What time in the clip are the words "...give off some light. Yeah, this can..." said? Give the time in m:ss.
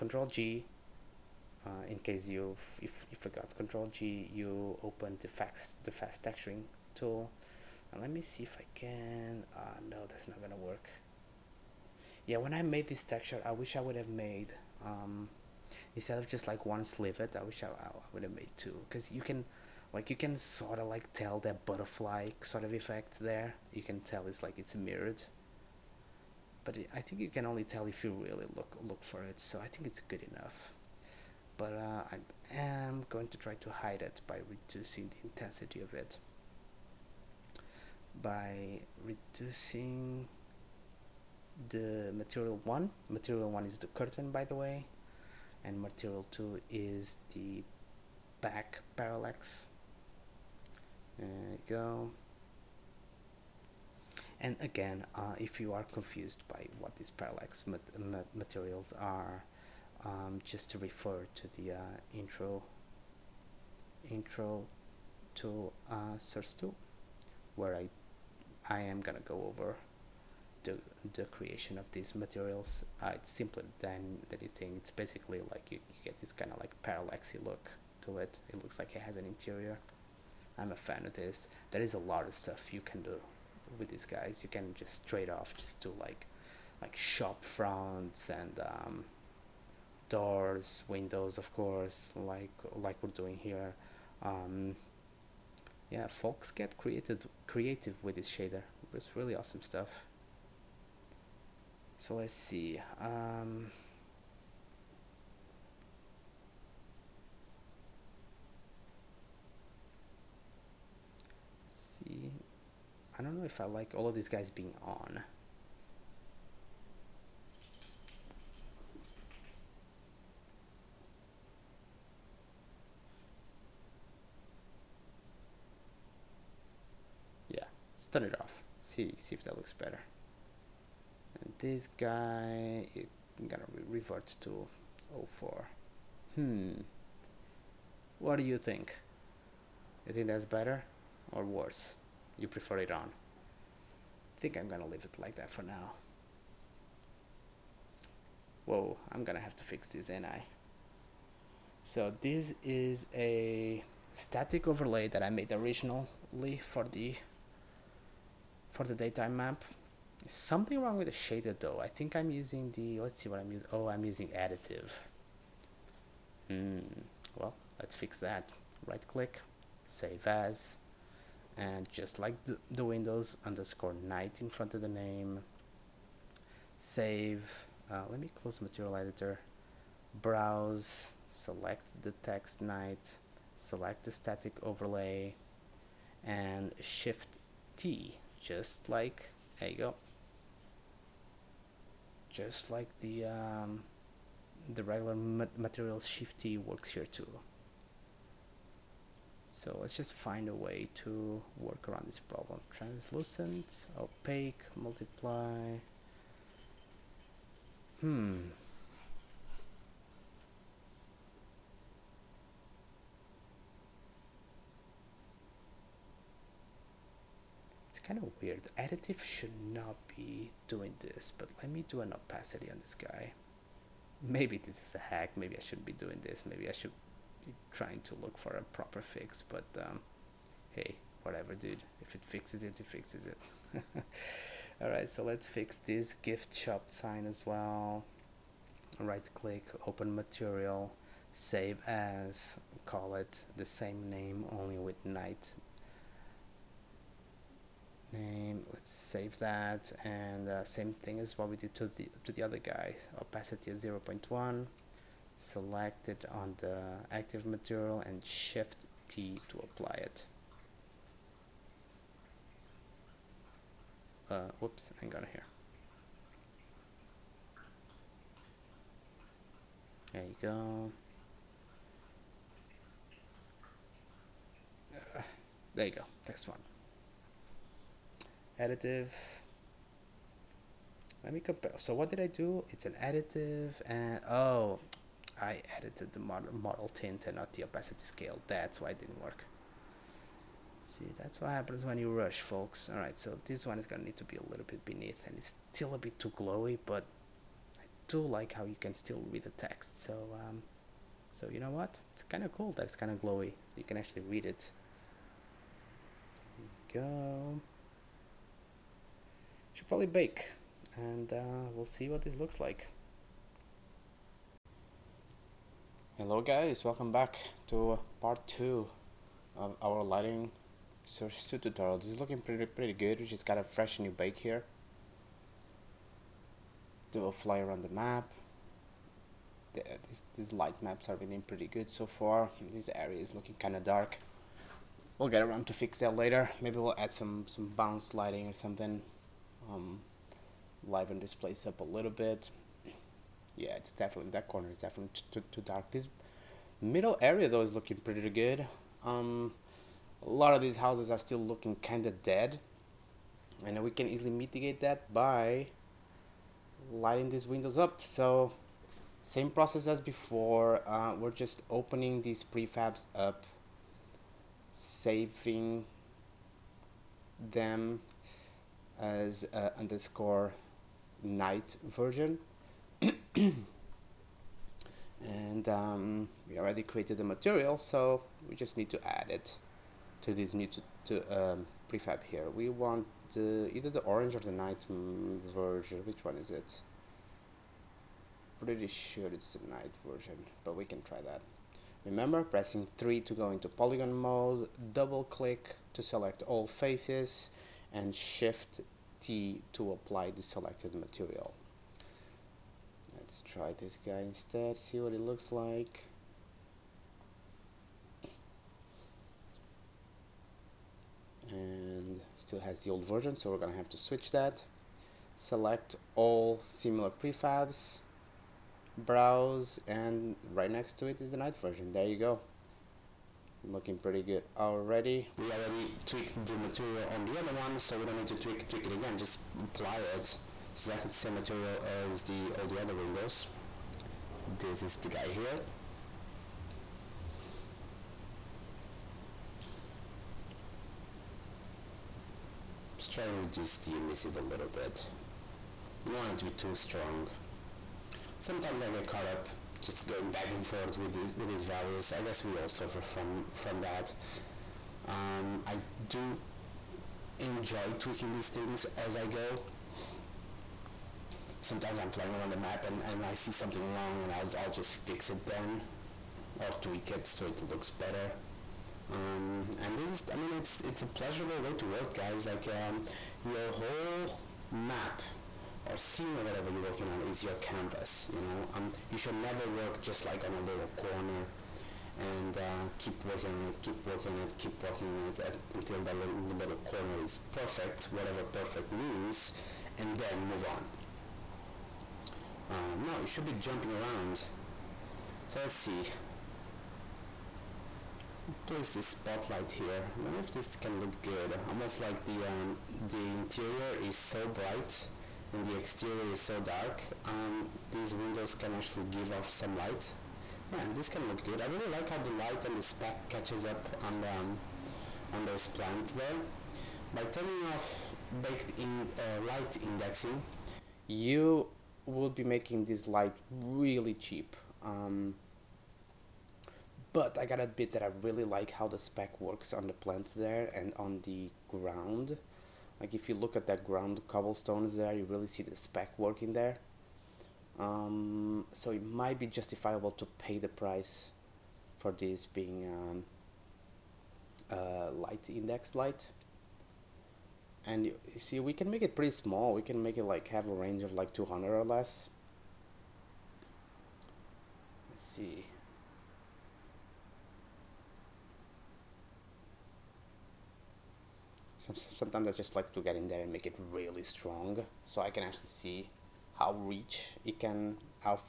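8:29.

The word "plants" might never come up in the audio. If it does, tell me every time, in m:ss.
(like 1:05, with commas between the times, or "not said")
8:35, 8:49.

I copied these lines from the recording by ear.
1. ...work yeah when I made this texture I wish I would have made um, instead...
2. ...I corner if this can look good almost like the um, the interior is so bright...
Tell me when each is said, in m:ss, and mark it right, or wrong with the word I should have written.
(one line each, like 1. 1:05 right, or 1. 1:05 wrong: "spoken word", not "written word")
1. 0:10 right
2. 8:20 wrong: "wonder", not "corner".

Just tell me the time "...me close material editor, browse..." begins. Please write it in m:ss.
2:58.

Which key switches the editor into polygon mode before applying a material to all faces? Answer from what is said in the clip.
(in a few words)
3.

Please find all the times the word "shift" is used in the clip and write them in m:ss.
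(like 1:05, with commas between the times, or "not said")
3:06, 3:16, 4:18, 6:38.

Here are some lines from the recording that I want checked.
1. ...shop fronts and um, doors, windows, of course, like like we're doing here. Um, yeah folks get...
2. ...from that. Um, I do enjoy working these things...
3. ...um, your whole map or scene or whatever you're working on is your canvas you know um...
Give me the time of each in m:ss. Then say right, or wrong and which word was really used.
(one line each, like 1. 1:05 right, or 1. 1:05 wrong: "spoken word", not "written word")
1. 1:26 right
2. 7:33 wrong: "tweaking", not "working"
3. 7:52 right.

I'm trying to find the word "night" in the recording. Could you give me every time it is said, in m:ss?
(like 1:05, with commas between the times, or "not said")
2:53, 3:02, 4:05, 6:11, 6:24, 6:29, 7:01.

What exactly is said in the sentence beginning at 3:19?
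So let's just find a way to work around this problem.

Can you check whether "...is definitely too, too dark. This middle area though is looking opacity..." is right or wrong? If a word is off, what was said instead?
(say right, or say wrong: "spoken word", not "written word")
wrong: "pretty", not "opacity".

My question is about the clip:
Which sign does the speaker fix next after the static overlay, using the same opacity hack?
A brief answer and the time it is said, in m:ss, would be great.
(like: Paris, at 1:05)
gift shop sign, at 3:56.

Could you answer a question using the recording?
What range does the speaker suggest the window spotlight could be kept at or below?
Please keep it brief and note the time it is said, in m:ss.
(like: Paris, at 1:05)
200, at 9:11.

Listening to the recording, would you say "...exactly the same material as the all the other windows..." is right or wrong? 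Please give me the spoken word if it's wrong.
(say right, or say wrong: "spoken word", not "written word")
right.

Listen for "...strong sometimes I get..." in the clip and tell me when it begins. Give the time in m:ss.
7:26.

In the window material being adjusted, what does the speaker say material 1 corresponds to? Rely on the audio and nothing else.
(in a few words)
the curtain.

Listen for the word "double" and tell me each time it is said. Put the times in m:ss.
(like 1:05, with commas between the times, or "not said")
6:34.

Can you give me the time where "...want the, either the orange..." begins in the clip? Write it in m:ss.
6:22.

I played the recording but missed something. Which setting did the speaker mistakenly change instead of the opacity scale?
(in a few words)
model tint.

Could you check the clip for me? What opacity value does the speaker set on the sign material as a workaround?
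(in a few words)
0.1.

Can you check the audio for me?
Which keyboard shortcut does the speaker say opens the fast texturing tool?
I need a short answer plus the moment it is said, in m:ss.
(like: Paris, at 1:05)
Control G, at 0:03.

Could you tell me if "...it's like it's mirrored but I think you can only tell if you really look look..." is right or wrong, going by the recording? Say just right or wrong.
right.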